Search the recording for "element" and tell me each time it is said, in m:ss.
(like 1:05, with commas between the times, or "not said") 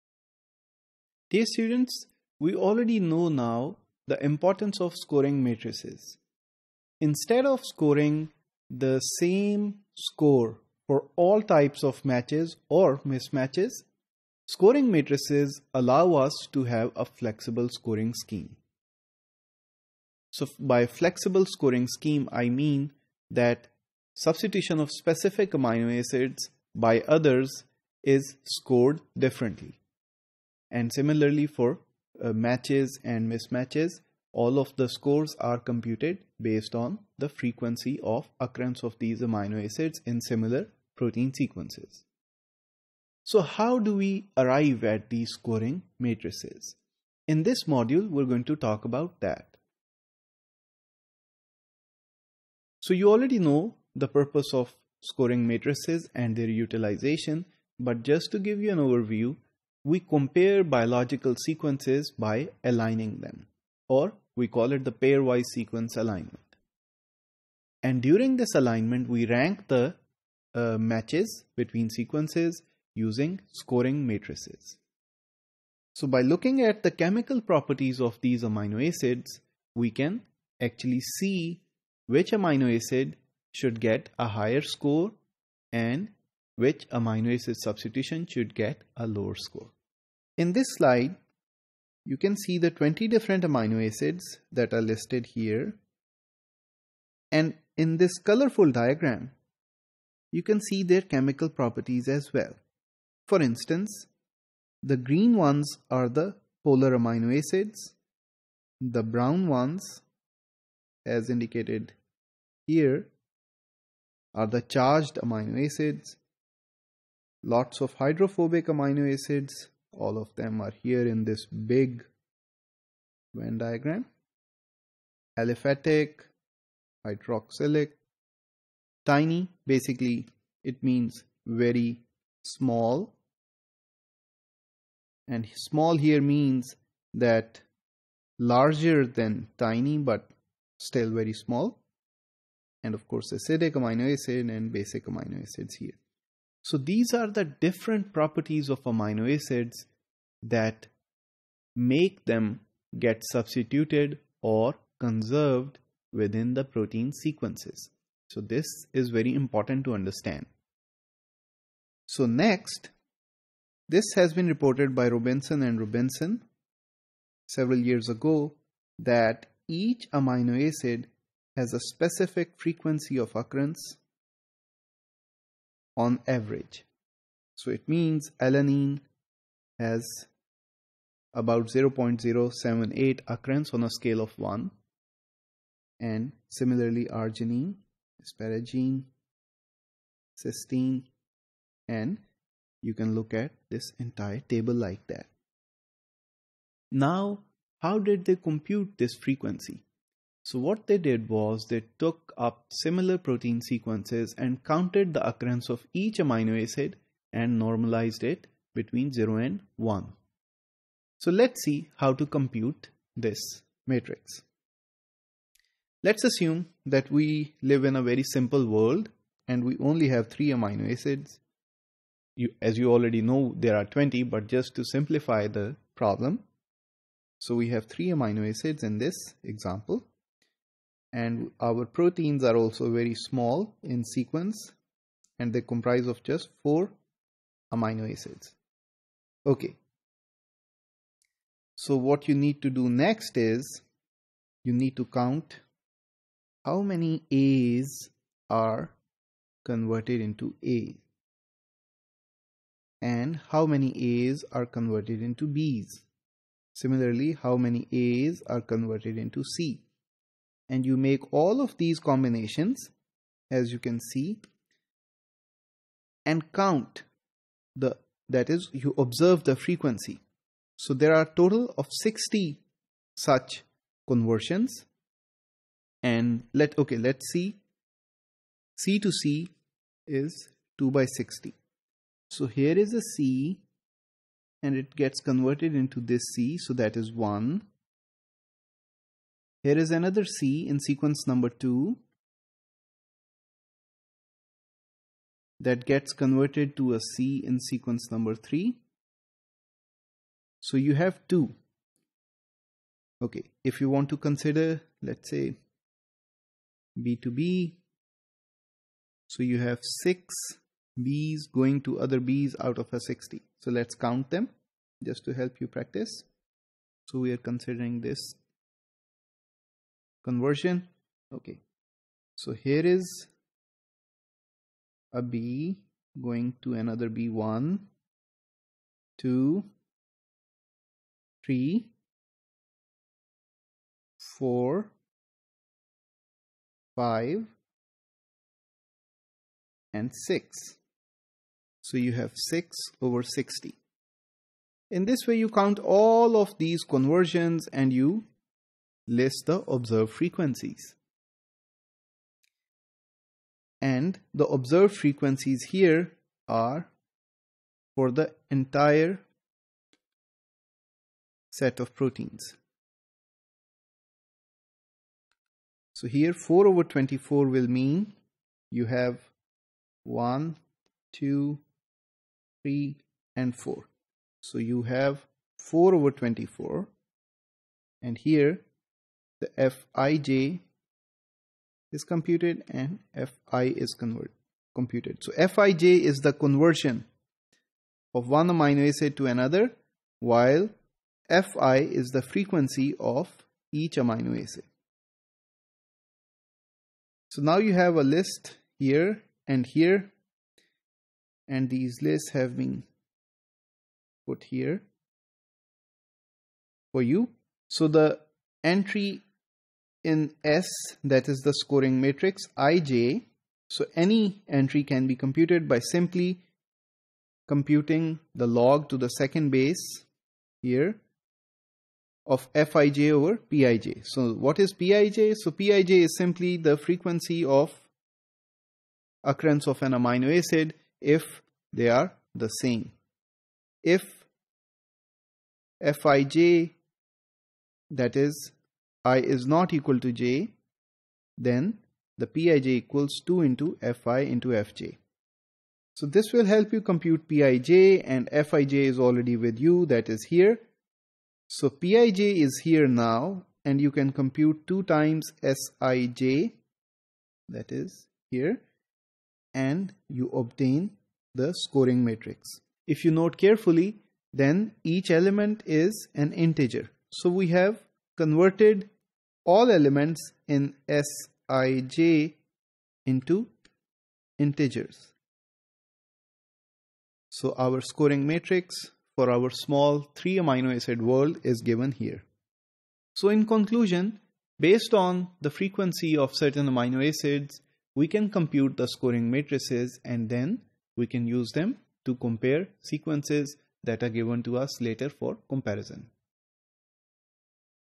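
7:45, 7:49.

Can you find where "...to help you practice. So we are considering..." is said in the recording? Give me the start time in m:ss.
5:15.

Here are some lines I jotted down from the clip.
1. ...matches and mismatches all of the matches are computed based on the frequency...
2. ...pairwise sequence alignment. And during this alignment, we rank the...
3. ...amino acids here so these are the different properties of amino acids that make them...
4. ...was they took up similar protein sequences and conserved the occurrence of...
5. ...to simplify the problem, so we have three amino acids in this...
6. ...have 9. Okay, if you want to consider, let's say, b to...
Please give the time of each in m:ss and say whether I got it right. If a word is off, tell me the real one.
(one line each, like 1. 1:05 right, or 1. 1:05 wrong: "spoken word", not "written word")
1. 0:32 wrong: "scores", not "matches"
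2. 1:04 right
3. 2:25 right
4. 3:21 wrong: "counted", not "conserved"
5. 3:44 right
6. 5:00 wrong: "2", not "9".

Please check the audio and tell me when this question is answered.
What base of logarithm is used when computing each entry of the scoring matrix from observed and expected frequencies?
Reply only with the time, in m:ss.
6:59.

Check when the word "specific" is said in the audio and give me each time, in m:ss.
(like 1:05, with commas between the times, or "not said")
0:24, 2:51.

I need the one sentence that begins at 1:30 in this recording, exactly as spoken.
In this slide, you can see the 20 different amino acids that are listed here.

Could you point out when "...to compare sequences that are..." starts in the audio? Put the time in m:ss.
8:12.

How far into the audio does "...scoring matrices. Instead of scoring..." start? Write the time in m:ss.
0:04.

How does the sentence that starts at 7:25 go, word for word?
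So this will help you compute Pij and Fij is already with you that is here.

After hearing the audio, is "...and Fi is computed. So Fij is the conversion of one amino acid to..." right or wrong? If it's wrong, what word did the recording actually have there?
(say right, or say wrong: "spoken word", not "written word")
right.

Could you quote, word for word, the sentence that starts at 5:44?
In this way you count all of these conversions and you list the observed frequencies.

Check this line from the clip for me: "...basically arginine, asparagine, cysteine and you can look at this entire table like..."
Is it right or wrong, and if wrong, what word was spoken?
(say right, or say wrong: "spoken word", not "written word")
wrong: "similarly", not "basically".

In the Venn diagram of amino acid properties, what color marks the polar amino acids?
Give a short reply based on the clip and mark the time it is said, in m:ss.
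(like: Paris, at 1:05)
Green, at 1:44.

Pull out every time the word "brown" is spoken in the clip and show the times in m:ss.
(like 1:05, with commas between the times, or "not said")
1:49.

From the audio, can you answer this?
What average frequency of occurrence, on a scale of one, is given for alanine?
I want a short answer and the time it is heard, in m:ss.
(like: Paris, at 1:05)
0.078, at 3:01.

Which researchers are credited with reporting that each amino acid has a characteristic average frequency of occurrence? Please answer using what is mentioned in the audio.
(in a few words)
Robinson and Robinson.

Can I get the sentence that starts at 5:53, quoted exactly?
And the observed frequencies here are for the entire set of proteins.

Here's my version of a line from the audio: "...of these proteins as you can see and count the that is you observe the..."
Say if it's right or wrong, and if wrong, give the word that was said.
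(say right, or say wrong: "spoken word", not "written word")
wrong: "combinations", not "proteins".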